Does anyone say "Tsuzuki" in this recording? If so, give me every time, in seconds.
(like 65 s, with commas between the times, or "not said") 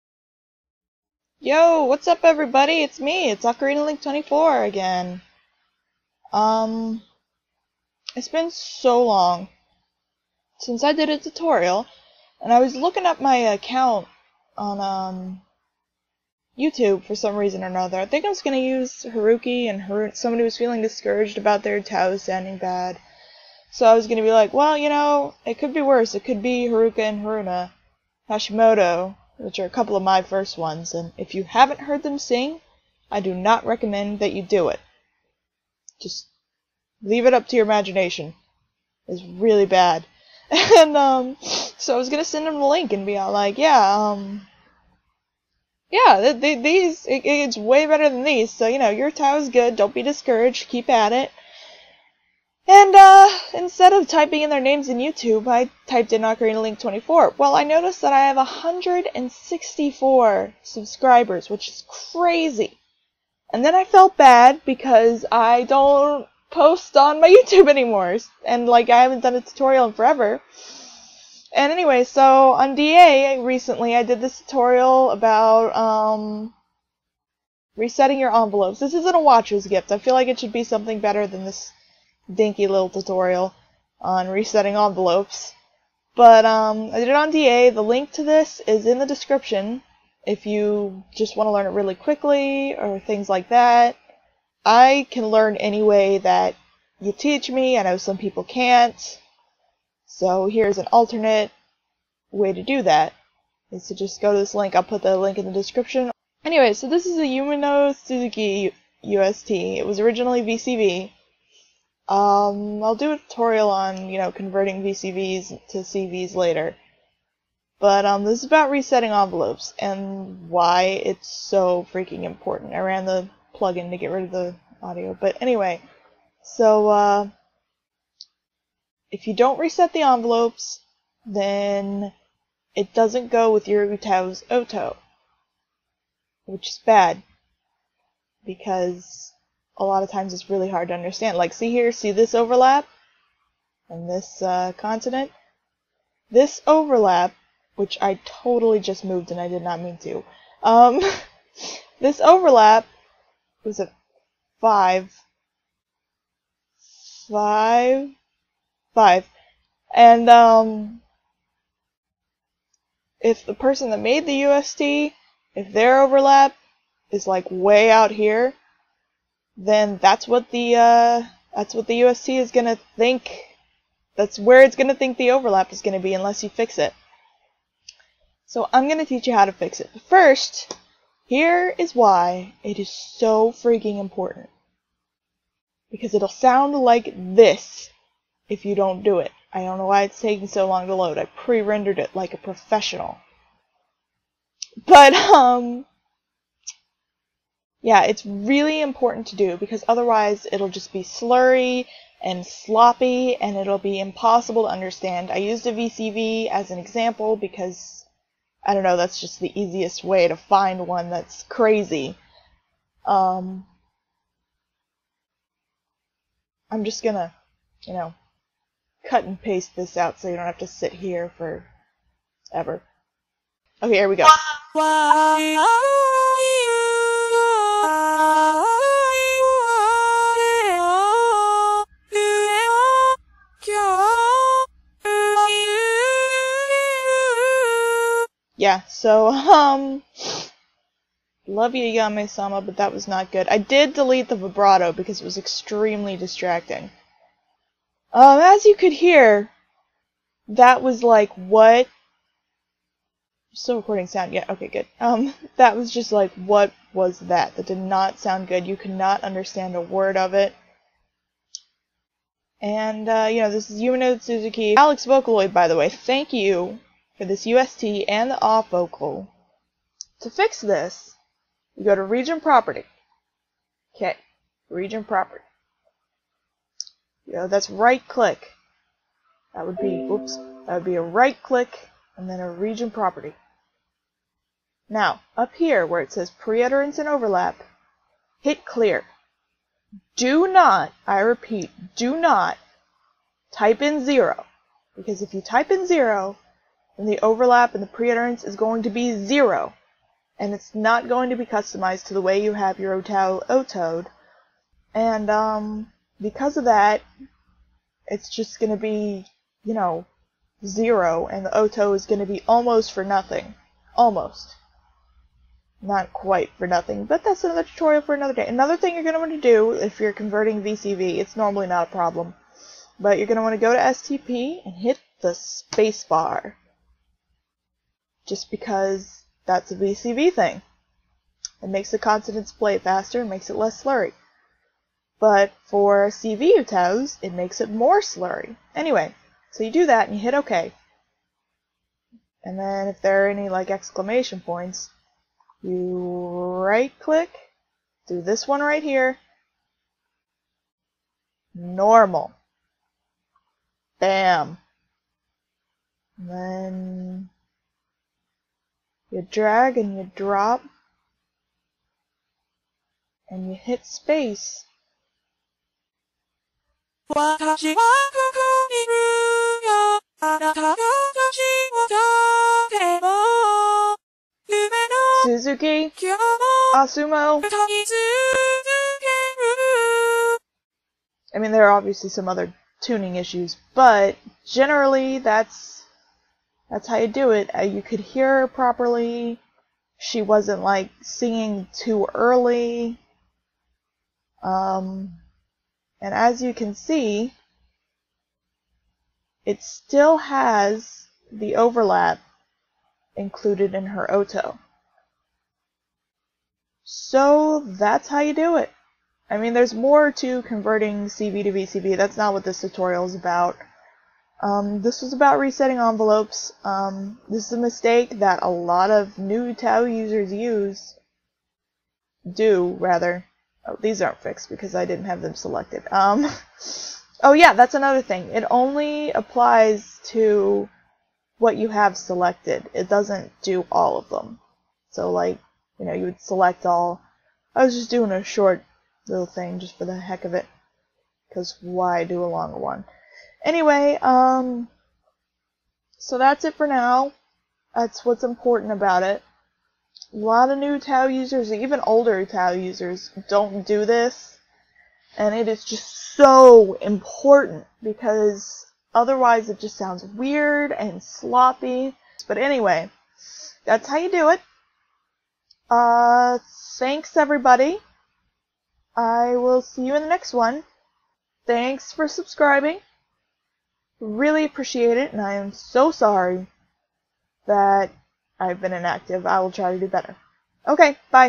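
107 s, 264 s.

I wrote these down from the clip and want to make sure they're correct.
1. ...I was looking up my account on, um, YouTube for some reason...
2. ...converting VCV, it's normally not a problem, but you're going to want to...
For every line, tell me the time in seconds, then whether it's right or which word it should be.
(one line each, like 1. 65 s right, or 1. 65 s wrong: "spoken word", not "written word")
1. 12 s right
2. 320 s right.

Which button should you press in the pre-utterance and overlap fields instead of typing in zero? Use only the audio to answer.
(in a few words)
Clear.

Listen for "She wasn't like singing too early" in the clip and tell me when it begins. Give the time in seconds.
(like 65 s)
389 s.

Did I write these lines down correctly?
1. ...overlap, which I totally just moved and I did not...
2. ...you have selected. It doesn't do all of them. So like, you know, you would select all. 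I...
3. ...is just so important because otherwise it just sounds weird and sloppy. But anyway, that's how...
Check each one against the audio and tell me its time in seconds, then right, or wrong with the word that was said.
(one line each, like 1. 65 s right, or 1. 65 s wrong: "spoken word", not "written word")
1. 146 s right
2. 431 s right
3. 455 s right.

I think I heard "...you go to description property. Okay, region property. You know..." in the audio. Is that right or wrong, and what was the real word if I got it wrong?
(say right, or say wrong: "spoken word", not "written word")
wrong: "region", not "description".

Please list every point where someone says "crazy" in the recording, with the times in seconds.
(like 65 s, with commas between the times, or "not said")
61 s, 211 s.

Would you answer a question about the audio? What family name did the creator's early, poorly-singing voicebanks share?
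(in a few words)
Hashimoto.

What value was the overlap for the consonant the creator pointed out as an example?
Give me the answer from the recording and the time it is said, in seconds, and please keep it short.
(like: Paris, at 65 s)
555, at 154 s.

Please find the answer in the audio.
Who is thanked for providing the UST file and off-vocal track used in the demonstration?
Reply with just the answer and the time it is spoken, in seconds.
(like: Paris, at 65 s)
Alex Vocaloid, at 264 s.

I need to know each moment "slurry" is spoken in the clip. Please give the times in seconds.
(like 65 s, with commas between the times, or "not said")
201 s, 333 s, 337 s.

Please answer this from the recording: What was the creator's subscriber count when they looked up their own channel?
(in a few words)
164.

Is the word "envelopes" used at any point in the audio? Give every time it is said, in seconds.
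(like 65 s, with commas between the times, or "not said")
78 s, 84 s, 119 s, 130 s, 415 s.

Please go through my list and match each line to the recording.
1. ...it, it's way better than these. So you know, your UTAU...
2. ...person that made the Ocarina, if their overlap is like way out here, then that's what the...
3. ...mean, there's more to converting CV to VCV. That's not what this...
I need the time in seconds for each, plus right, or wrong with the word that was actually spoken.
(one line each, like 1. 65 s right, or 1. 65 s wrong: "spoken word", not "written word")
1. 47 s right
2. 163 s wrong: "UST", not "Ocarina"
3. 409 s right.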